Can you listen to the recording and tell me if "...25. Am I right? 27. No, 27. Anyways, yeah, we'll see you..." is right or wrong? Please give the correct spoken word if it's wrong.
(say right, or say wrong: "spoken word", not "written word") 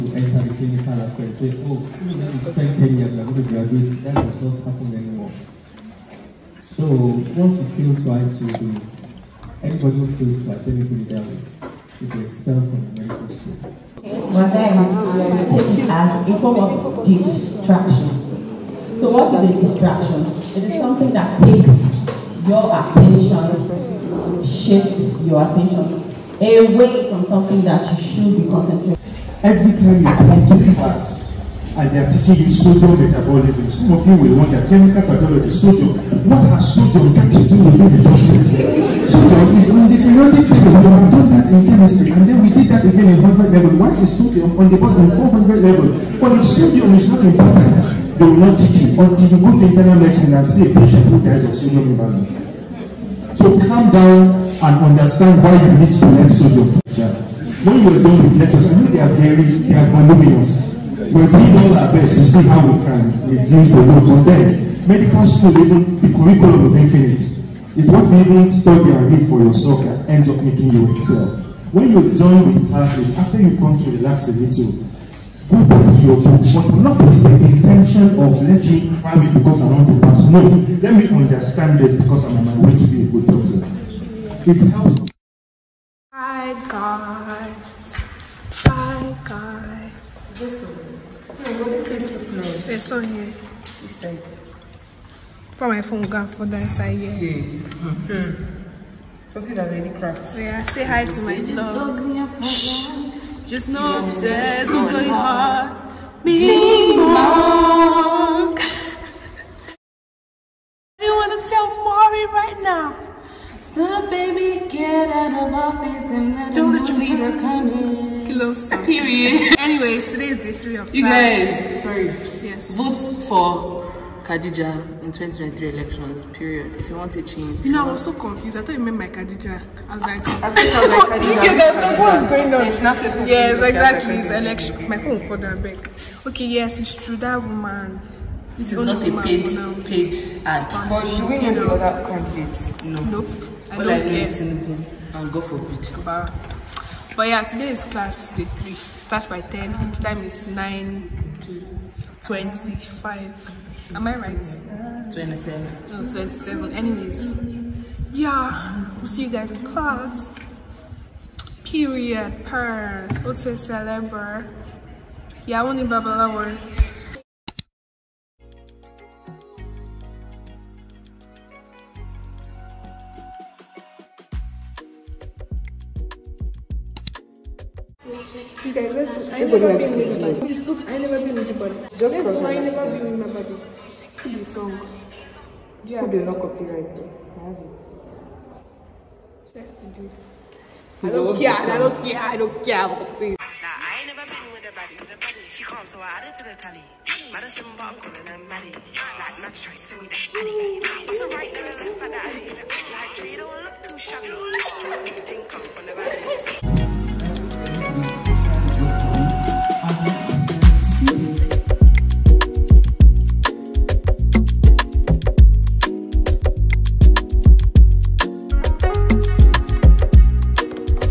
right.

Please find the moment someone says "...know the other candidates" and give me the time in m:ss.
2:21.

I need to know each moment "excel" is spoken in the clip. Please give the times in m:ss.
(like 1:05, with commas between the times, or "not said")
1:10.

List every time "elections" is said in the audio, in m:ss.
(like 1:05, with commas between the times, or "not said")
2:05, 2:14.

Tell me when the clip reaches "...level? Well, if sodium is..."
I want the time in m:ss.
0:45.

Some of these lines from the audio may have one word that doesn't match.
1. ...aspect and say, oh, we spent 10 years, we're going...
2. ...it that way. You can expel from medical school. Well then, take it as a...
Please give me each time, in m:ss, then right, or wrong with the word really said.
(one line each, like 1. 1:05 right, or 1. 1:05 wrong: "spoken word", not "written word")
1. 0:00 right
2. 0:11 right.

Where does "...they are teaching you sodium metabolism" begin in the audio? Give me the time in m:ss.
0:31.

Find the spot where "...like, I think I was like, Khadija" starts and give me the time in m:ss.
2:10.